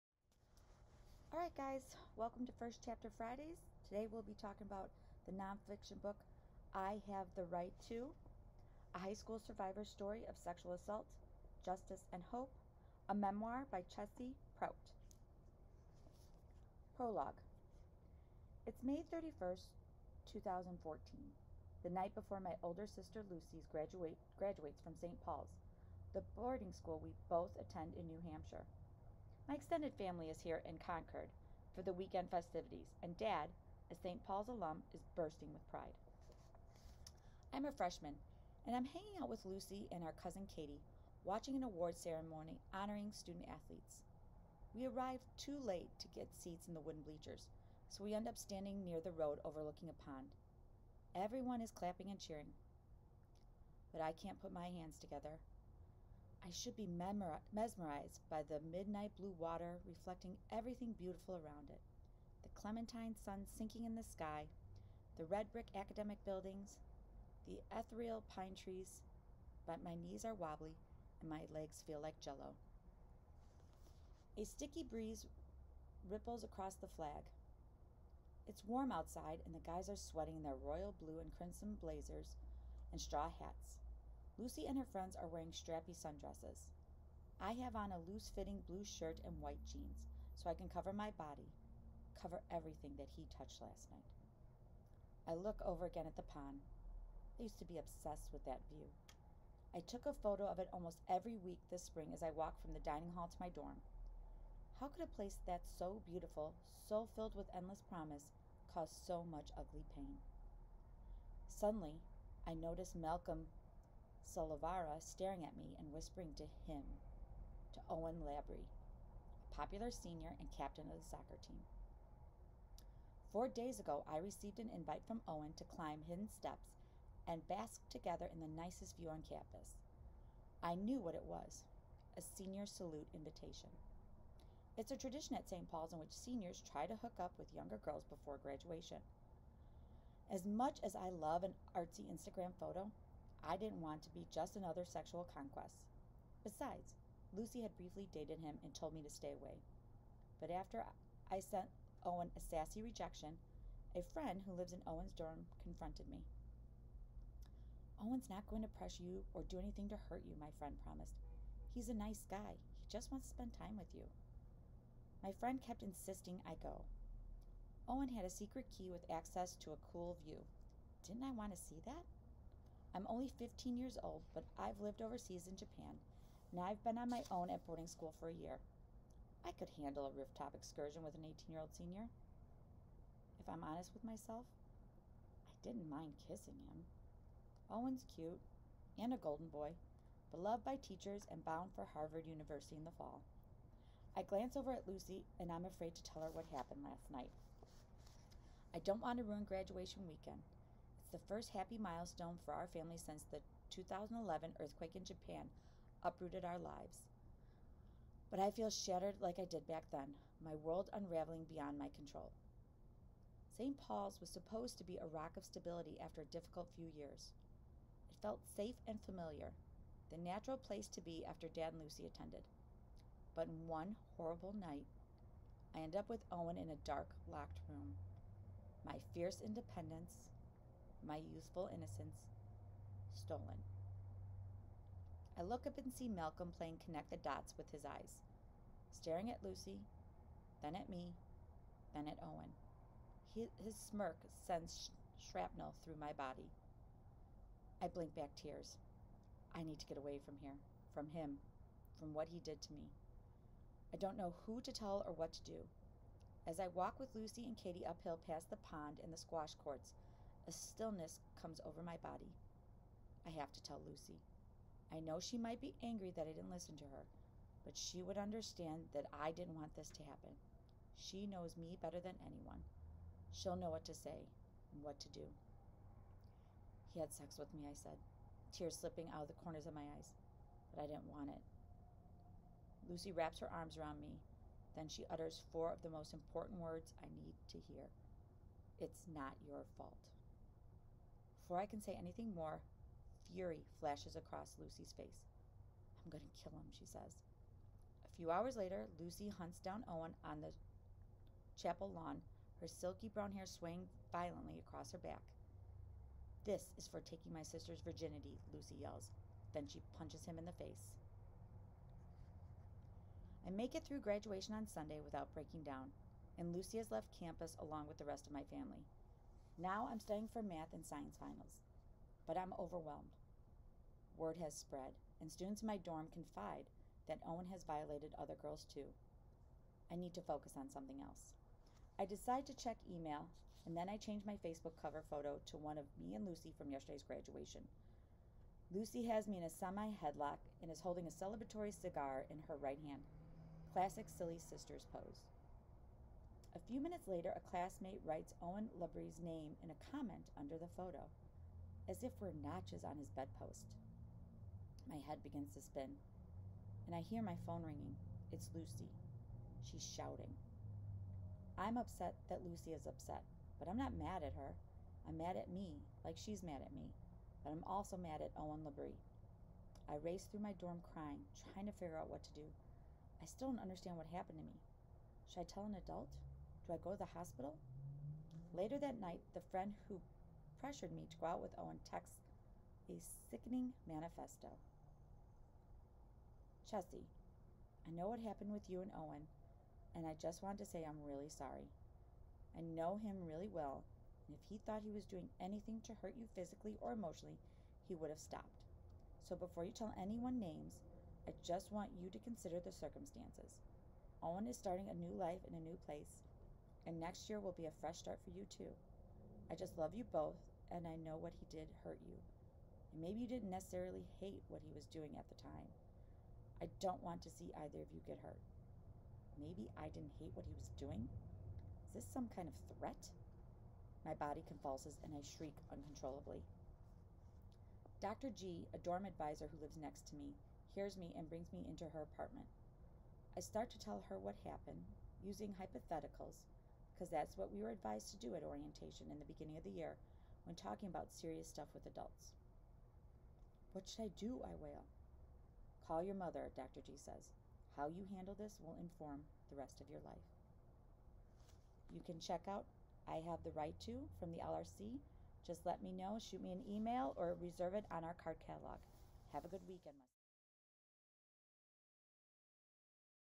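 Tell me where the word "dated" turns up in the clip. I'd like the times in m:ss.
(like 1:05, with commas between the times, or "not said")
2:28.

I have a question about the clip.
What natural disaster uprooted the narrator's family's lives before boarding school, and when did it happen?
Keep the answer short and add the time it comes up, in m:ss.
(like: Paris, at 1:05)
2011 earthquake, at 3:23.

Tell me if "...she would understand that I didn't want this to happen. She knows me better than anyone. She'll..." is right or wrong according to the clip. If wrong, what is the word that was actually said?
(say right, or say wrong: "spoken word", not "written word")
right.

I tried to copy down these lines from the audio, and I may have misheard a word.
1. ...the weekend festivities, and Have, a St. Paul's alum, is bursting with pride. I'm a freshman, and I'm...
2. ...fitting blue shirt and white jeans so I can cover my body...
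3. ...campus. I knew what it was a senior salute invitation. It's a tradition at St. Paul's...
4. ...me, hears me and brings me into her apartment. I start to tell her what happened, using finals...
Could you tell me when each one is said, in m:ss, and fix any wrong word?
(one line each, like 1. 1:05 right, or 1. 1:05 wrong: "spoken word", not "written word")
1. 0:31 wrong: "Dad", not "Have"
2. 1:28 right
3. 2:09 right
4. 7:10 wrong: "hypotheticals", not "finals".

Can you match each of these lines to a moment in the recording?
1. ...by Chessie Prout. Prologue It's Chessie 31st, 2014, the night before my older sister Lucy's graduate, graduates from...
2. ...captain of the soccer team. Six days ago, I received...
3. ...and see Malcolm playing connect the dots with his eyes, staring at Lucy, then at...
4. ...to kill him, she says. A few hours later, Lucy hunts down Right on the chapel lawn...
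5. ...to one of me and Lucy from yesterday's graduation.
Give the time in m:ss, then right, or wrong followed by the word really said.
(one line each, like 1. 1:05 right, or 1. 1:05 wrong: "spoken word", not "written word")
1. 0:13 wrong: "May", not "Chessie"
2. 2:00 wrong: "Four", not "Six"
3. 3:55 right
4. 4:56 wrong: "Owen", not "Right"
5. 5:35 right.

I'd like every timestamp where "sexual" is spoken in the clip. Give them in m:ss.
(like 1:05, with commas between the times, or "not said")
0:10, 2:24.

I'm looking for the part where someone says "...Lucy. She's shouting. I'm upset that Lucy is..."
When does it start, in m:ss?
5:58.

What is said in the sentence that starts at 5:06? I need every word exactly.
This is for taking my sister's virginity, Lucy yells.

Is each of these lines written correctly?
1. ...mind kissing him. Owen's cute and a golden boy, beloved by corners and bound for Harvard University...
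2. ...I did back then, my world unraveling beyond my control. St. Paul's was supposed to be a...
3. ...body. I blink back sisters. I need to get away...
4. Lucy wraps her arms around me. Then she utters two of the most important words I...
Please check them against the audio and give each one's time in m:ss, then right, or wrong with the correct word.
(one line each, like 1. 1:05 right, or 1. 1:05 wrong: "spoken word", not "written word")
1. 3:05 wrong: "teachers", not "corners"
2. 3:29 right
3. 4:06 wrong: "tears", not "sisters"
4. 4:42 wrong: "four", not "two".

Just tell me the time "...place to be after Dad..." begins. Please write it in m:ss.
3:40.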